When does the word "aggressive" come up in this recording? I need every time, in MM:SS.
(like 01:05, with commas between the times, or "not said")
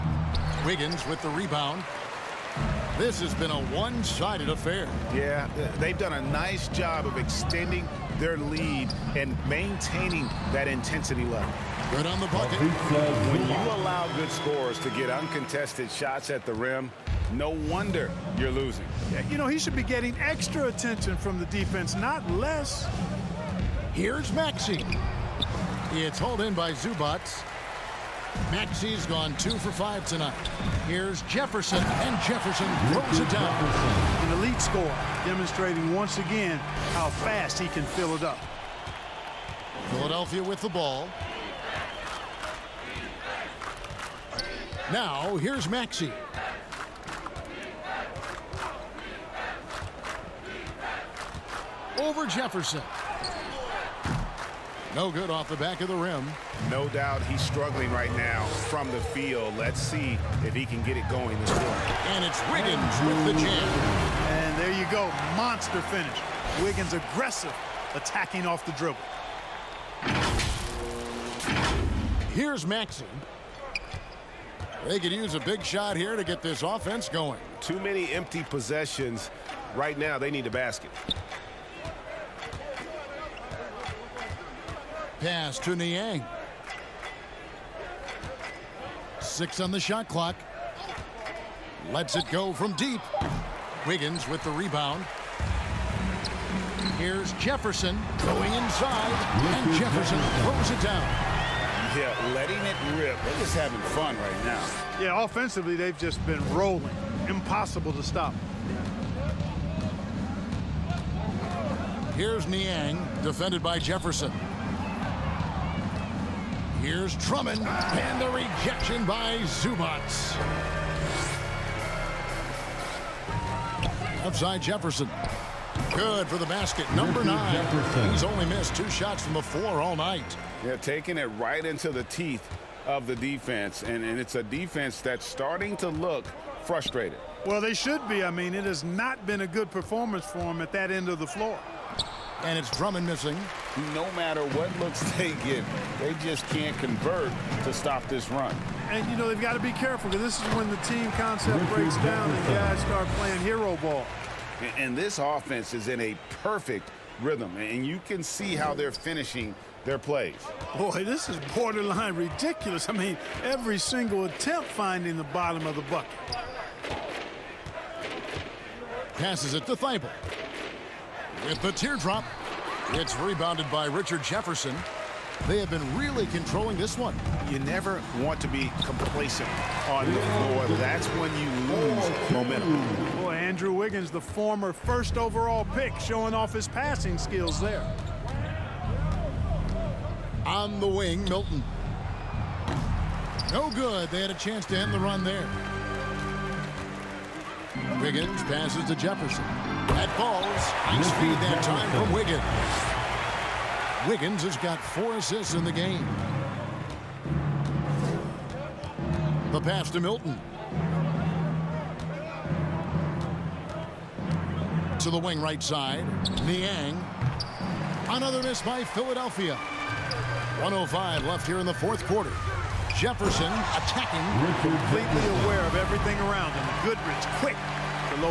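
01:06.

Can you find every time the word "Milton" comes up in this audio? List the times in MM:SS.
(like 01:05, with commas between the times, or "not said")
03:11, 03:30.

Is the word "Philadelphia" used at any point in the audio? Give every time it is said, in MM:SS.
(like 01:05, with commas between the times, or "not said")
00:39, 03:38.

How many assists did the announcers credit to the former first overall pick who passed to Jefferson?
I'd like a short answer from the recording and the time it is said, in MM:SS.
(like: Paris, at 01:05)
4, at 03:24.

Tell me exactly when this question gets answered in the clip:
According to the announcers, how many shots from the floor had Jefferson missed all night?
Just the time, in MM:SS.
02:08.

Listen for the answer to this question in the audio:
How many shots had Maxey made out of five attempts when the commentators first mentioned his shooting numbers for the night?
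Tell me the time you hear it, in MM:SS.
00:29.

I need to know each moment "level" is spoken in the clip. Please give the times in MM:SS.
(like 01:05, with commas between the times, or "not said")
00:11.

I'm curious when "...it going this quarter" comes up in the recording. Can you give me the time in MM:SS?
01:00.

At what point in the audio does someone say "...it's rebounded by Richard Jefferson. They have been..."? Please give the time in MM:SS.
02:52.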